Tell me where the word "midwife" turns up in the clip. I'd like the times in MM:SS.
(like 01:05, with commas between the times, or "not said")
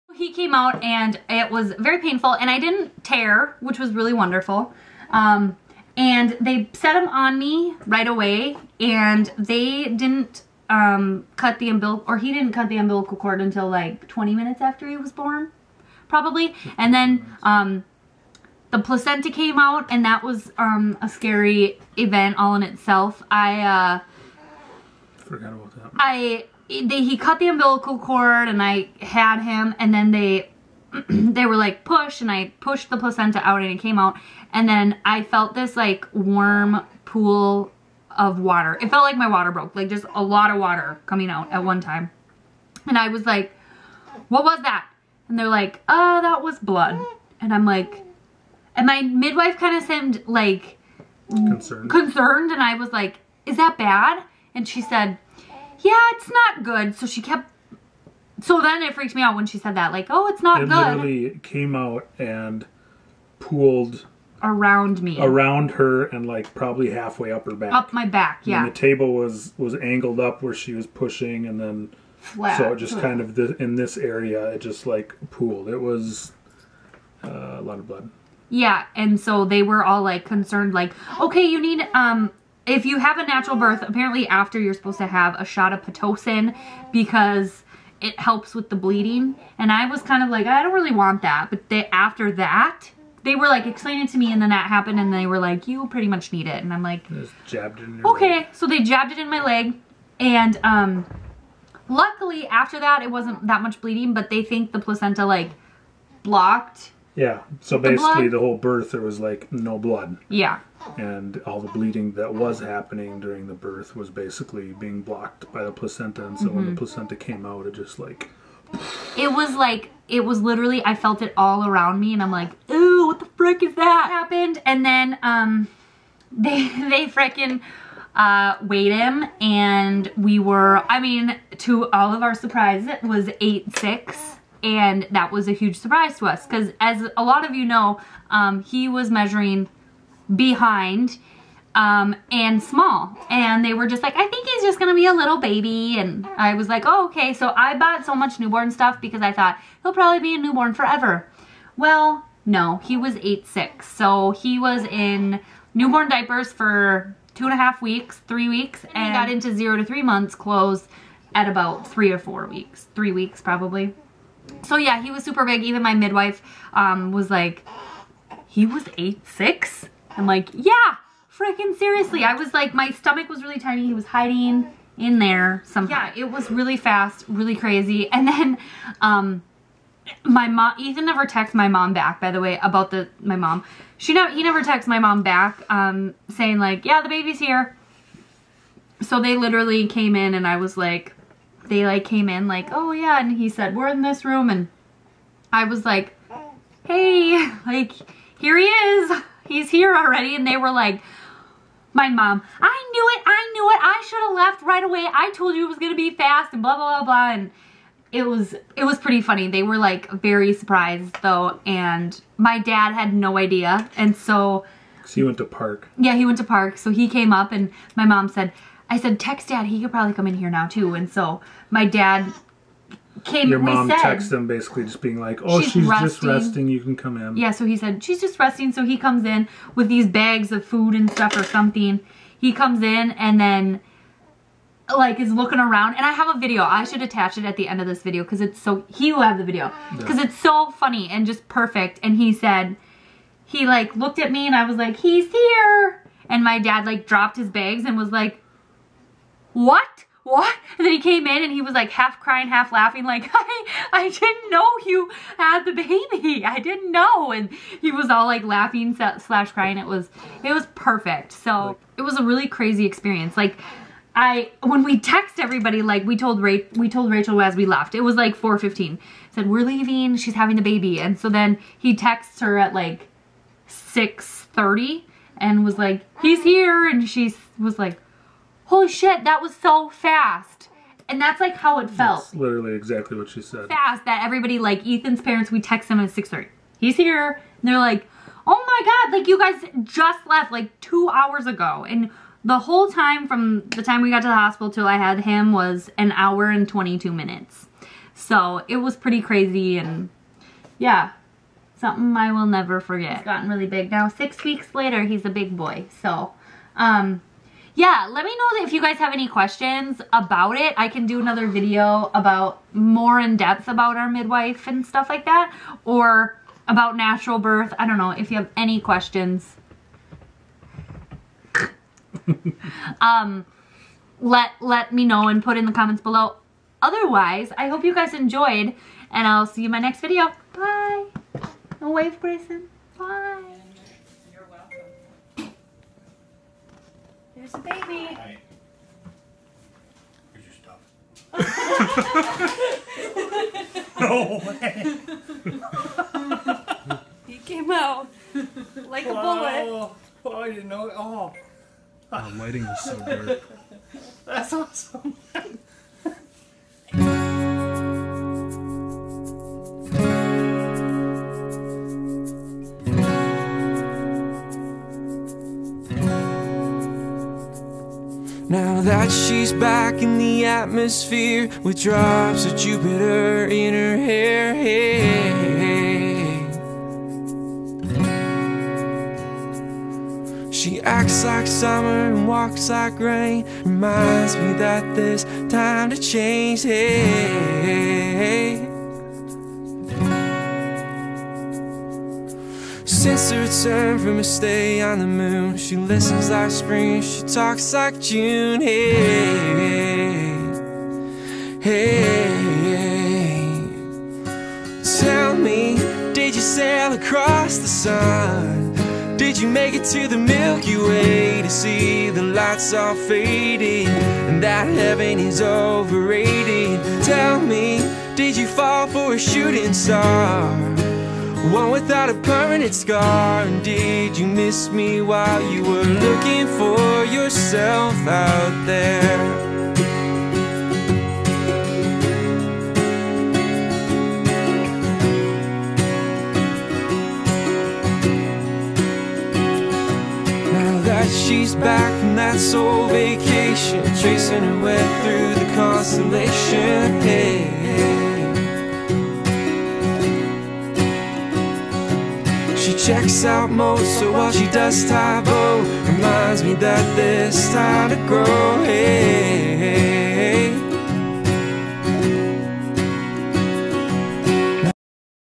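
00:49, 02:45, 05:14.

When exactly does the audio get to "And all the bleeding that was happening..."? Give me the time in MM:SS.
01:50.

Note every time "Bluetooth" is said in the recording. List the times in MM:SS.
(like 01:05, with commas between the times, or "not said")
not said.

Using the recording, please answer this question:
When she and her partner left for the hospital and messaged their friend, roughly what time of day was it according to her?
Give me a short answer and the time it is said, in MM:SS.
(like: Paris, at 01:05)
4:15, at 04:28.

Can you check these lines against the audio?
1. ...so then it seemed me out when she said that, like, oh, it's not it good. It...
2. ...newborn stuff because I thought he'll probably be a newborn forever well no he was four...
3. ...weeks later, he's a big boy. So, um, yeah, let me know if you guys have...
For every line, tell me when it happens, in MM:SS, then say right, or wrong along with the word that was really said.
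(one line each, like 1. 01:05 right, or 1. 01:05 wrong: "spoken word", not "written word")
1. 00:58 wrong: "freaked", not "seemed"
2. 02:28 wrong: "eight", not "four"
3. 05:04 right.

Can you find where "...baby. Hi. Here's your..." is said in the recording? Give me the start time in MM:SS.
05:37.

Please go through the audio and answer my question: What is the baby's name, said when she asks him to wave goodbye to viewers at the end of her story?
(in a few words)
Grayson.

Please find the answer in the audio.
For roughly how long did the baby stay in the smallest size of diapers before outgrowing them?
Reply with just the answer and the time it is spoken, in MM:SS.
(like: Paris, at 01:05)
2.5 weeks, at 02:37.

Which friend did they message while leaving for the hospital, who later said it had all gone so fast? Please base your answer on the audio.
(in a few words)
Rachel.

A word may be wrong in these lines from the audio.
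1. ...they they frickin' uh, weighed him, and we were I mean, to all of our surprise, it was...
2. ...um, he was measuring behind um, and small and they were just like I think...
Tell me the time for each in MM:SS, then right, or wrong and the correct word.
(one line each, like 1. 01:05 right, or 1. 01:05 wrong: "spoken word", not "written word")
1. 02:06 right
2. 02:18 right.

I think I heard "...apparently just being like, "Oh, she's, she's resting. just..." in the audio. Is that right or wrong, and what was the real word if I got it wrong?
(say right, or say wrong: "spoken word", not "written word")
wrong: "basically", not "apparently".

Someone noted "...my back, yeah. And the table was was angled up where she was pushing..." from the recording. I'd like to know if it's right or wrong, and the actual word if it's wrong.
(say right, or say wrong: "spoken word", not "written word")
right.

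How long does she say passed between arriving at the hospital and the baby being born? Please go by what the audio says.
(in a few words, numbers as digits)
1 hour and 22 minutes.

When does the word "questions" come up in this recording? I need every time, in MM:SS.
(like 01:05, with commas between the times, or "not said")
05:09, 05:18.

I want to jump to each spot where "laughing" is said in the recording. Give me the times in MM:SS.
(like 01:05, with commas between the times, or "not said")
04:12, 04:18.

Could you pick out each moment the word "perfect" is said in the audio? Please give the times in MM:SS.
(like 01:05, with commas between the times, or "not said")
04:01, 04:20.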